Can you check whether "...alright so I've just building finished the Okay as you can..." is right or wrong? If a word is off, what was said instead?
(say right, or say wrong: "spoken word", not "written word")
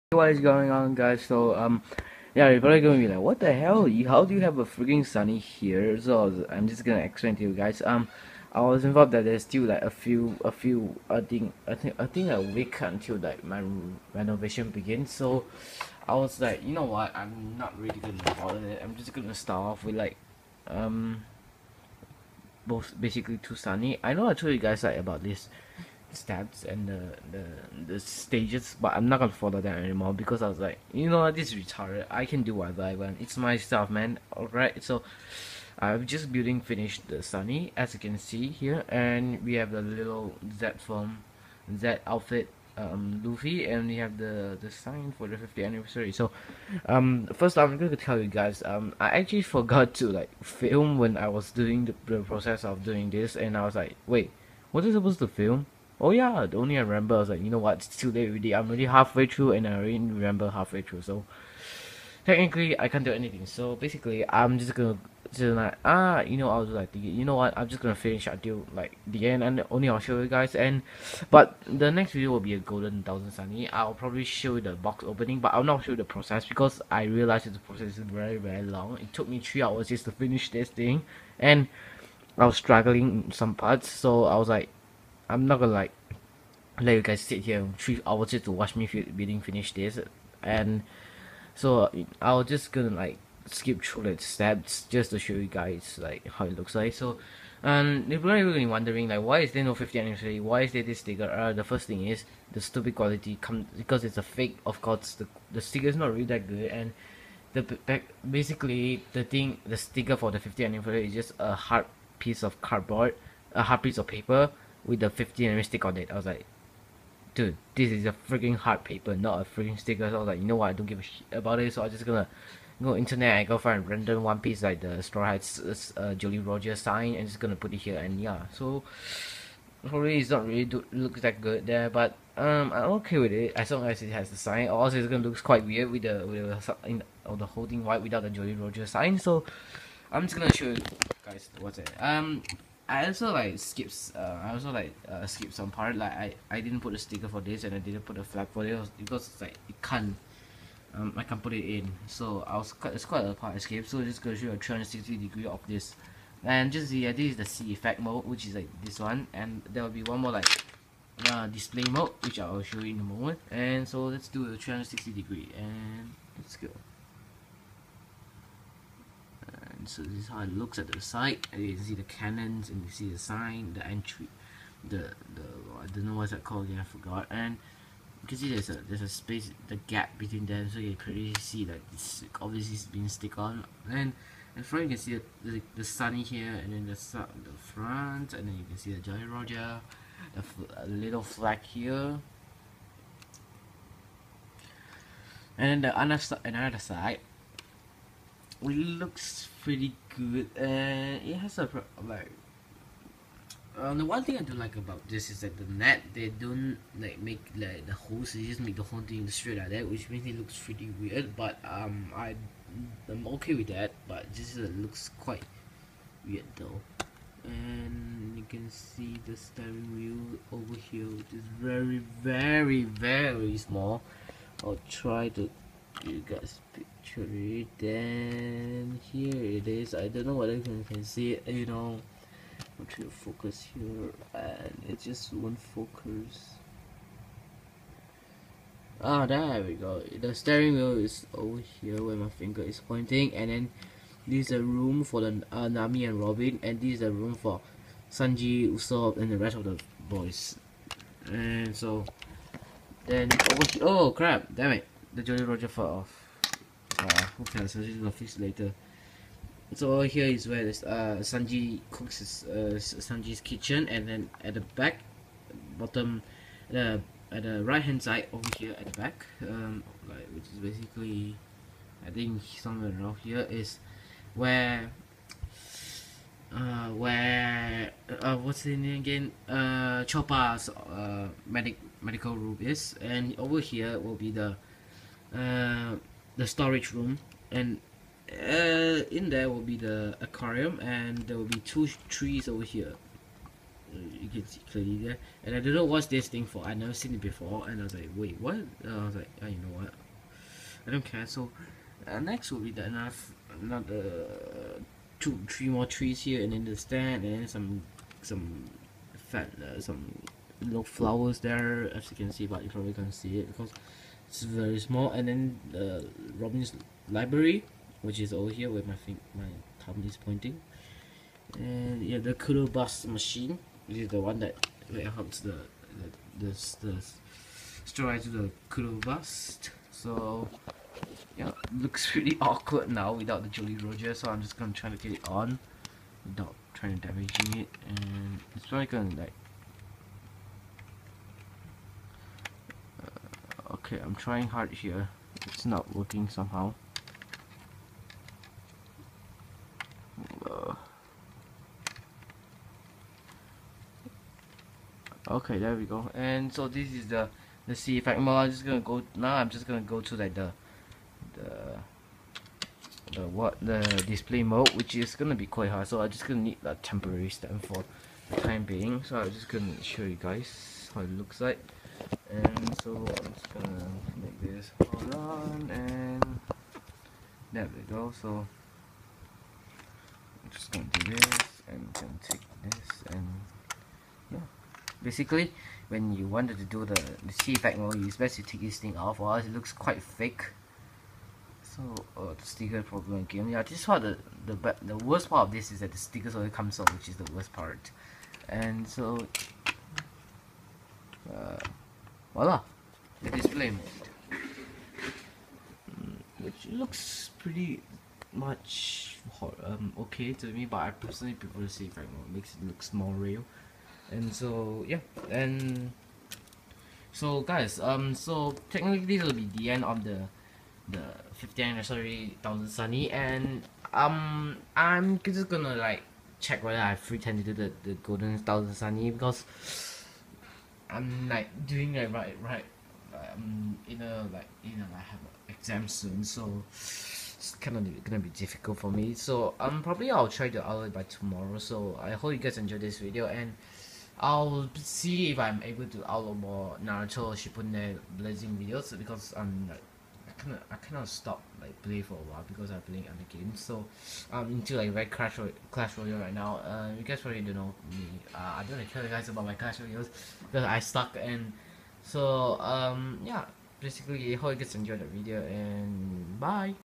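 wrong: "Sunny", not "Okay".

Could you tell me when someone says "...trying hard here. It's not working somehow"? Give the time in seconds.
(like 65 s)
344 s.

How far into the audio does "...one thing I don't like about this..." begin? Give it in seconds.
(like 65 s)
204 s.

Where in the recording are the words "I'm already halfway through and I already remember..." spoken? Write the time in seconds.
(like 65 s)
58 s.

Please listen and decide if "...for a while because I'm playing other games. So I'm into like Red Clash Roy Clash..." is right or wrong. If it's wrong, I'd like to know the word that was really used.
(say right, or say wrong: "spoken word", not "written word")
right.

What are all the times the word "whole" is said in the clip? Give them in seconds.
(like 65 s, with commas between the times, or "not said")
137 s, 208 s.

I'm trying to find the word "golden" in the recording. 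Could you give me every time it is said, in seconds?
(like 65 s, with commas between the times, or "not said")
72 s, 428 s.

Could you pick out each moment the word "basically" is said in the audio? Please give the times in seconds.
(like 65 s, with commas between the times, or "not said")
22 s, 63 s, 108 s, 270 s, 385 s, 463 s.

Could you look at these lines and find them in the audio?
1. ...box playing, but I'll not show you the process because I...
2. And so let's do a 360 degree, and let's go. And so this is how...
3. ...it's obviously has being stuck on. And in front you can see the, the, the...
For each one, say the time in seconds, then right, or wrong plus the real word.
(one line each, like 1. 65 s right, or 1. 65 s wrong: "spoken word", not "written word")
1. 74 s wrong: "opening", not "playing"
2. 163 s right
3. 181 s wrong: "stick", not "stuck".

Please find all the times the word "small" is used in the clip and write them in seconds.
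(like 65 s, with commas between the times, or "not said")
223 s, 314 s.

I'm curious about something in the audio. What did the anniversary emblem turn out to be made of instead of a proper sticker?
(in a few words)
hard piece of cardboard.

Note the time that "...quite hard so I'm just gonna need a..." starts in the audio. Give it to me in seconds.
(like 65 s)
365 s.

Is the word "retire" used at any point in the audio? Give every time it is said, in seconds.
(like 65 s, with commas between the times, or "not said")
not said.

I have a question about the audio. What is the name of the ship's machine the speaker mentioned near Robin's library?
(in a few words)
Coup de Burst machine.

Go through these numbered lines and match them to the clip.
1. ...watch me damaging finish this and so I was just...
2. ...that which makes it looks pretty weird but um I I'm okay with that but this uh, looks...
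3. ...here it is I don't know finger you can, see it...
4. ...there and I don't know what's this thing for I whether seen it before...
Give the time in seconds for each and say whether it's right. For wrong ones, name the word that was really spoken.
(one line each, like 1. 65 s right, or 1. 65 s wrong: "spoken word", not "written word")
1. 88 s wrong: "building", not "damaging"
2. 209 s right
3. 229 s wrong: "whether", not "finger"
4. 294 s wrong: "never", not "whether".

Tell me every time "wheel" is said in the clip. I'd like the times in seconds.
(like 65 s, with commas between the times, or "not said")
219 s, 240 s.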